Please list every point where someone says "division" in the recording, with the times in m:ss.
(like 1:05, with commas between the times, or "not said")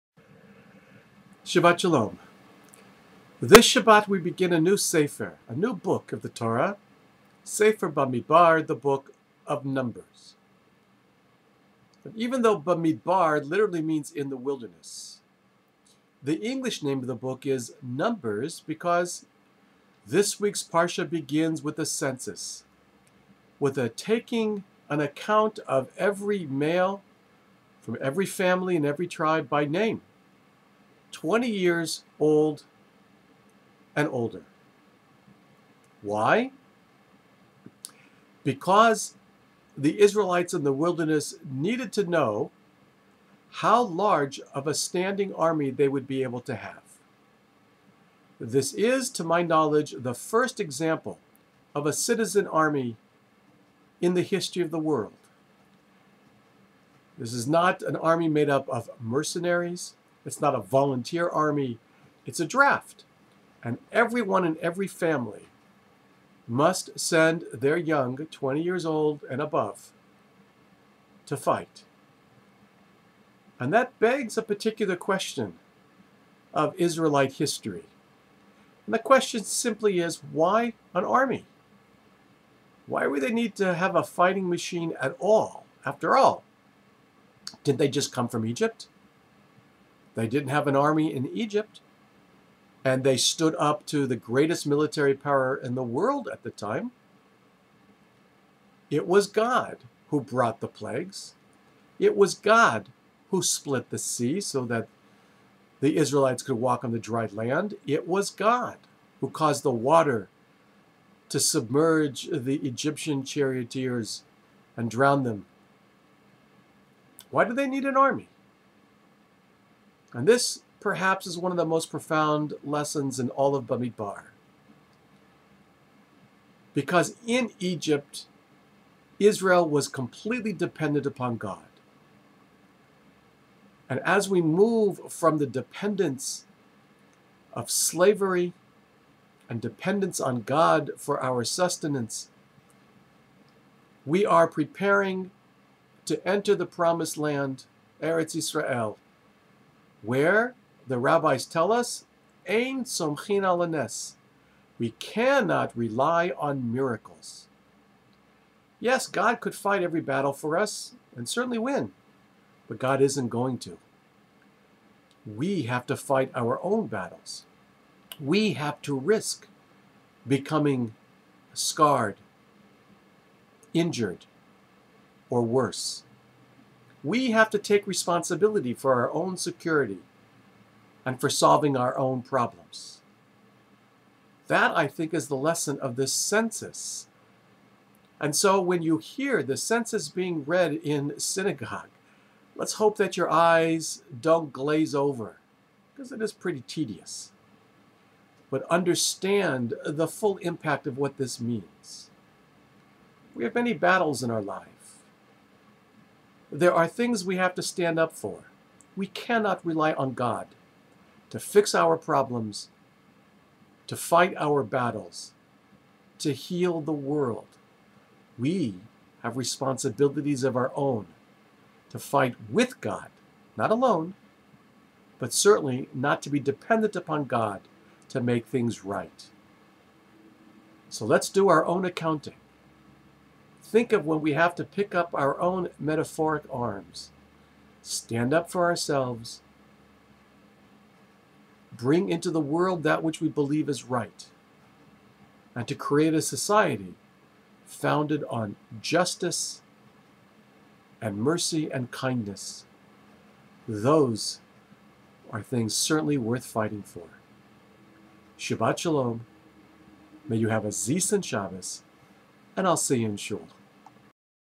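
not said.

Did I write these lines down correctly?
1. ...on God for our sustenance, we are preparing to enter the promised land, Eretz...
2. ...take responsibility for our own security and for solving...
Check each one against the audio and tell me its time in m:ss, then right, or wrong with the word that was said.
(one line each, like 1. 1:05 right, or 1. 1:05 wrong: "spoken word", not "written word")
1. 2:20 right
2. 2:57 right.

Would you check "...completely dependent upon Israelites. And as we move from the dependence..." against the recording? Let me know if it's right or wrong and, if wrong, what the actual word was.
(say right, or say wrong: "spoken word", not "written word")
wrong: "God", not "Israelites".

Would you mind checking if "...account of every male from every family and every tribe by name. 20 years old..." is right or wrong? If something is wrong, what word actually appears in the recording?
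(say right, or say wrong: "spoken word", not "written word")
right.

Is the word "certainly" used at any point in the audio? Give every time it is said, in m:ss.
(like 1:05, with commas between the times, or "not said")
2:41, 3:45, 4:15.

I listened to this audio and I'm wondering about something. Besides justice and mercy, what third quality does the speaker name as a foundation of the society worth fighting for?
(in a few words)
kindness.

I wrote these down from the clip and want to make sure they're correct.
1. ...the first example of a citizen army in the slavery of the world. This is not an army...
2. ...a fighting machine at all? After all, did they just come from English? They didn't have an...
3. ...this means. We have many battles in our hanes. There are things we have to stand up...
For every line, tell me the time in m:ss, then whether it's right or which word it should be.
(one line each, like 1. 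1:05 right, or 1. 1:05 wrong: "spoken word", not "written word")
1. 0:49 wrong: "history", not "slavery"
2. 1:23 wrong: "Egypt", not "English"
3. 3:21 wrong: "lives", not "hanes".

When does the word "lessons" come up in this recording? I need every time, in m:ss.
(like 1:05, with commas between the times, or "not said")
2:02, 3:05.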